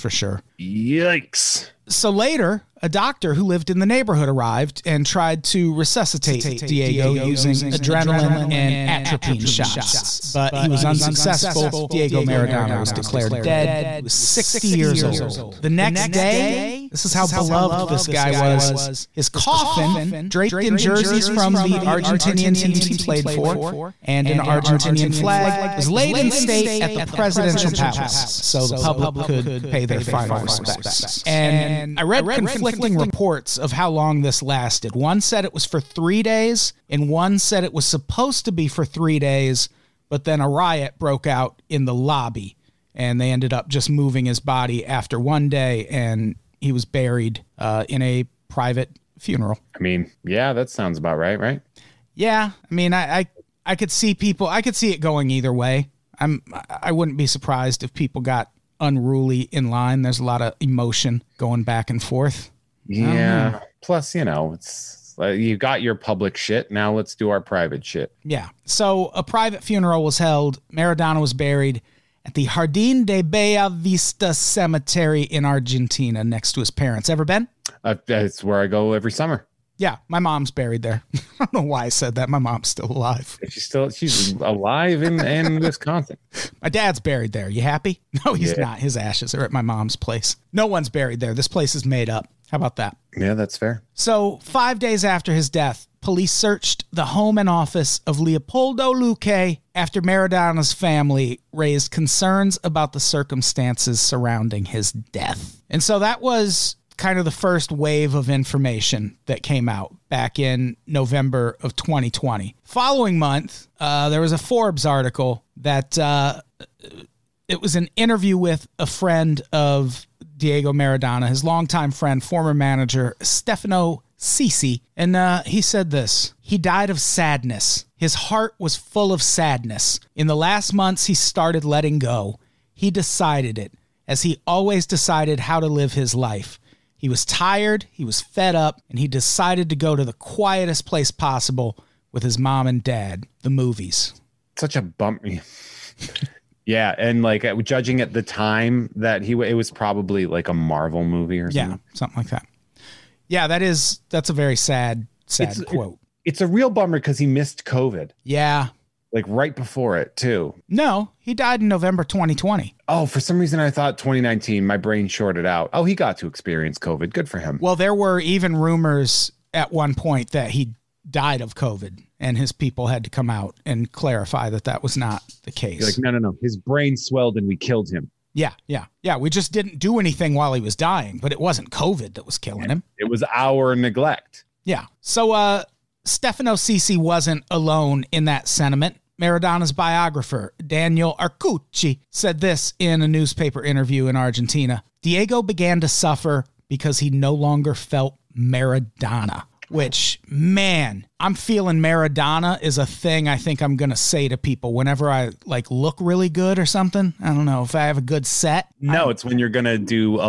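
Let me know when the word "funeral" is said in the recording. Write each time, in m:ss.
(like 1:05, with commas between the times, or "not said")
0:49, 1:09.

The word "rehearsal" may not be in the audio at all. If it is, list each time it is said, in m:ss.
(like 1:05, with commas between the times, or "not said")
not said.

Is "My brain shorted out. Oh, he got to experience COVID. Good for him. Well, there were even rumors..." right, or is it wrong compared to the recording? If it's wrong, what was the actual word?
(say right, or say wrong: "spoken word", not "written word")
right.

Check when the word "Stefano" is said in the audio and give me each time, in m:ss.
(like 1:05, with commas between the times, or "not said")
2:03, 3:06.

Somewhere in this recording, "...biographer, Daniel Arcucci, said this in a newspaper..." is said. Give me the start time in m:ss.
3:09.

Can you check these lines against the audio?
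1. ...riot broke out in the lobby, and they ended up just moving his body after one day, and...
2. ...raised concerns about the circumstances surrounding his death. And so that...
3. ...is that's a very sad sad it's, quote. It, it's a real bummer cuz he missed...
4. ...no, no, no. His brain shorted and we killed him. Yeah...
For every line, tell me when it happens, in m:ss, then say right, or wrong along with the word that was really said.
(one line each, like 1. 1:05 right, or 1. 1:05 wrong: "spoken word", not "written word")
1. 0:40 right
2. 1:41 right
3. 2:33 right
4. 2:55 wrong: "swelled", not "shorted".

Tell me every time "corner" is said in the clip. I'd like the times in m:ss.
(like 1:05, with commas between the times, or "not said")
not said.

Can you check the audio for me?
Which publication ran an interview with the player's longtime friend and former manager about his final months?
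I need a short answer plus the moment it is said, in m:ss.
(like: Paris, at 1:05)
Forbes, at 1:54.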